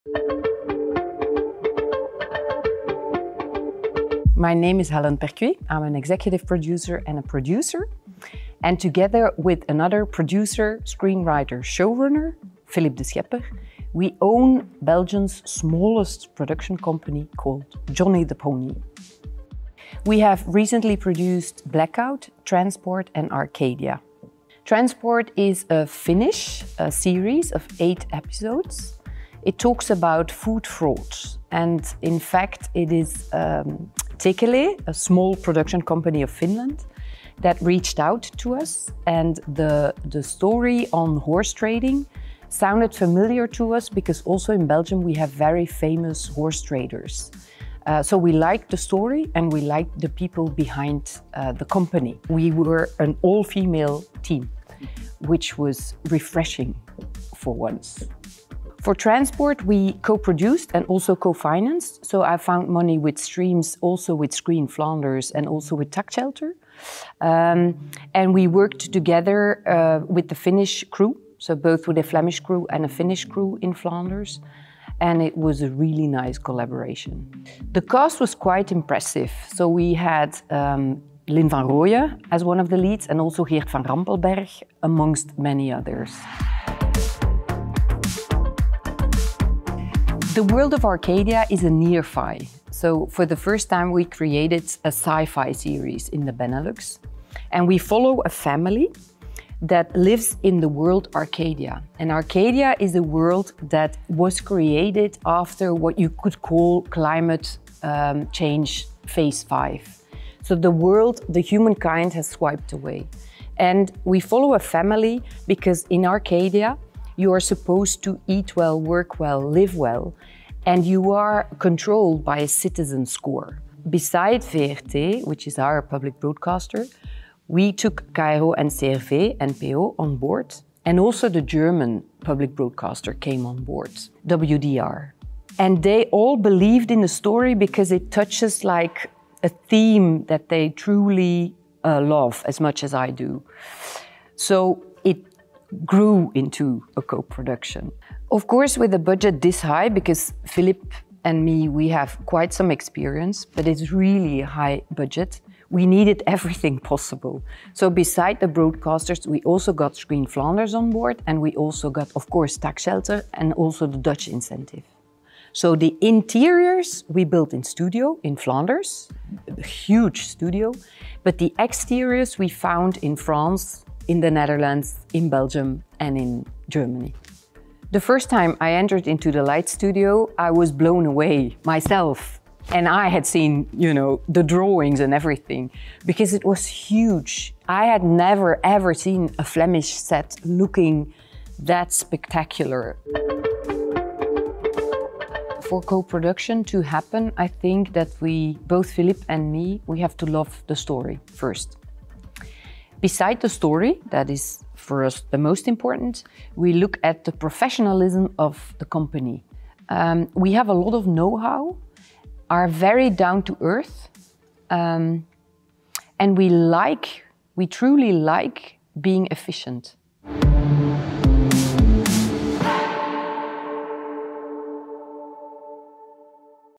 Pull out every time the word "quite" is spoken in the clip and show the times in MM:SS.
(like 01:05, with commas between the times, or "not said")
01:18, 02:32.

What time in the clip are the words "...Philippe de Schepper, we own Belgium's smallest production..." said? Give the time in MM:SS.
00:12.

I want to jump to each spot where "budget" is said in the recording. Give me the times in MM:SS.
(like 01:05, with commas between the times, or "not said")
02:28, 02:34.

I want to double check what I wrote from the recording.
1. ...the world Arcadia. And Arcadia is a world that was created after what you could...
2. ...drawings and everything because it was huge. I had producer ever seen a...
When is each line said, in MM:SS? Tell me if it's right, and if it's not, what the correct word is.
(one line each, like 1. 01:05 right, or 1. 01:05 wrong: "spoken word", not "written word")
1. 01:40 right
2. 03:04 wrong: "never", not "producer".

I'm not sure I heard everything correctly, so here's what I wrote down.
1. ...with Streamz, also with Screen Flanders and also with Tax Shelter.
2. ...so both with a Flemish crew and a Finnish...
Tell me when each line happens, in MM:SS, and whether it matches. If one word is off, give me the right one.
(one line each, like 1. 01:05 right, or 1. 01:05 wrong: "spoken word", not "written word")
1. 01:02 right
2. 01:11 right.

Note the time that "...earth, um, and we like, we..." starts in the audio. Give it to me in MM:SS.
03:33.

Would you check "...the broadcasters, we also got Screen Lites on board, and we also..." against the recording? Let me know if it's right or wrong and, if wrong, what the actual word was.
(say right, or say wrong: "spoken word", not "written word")
wrong: "Flanders", not "Lites".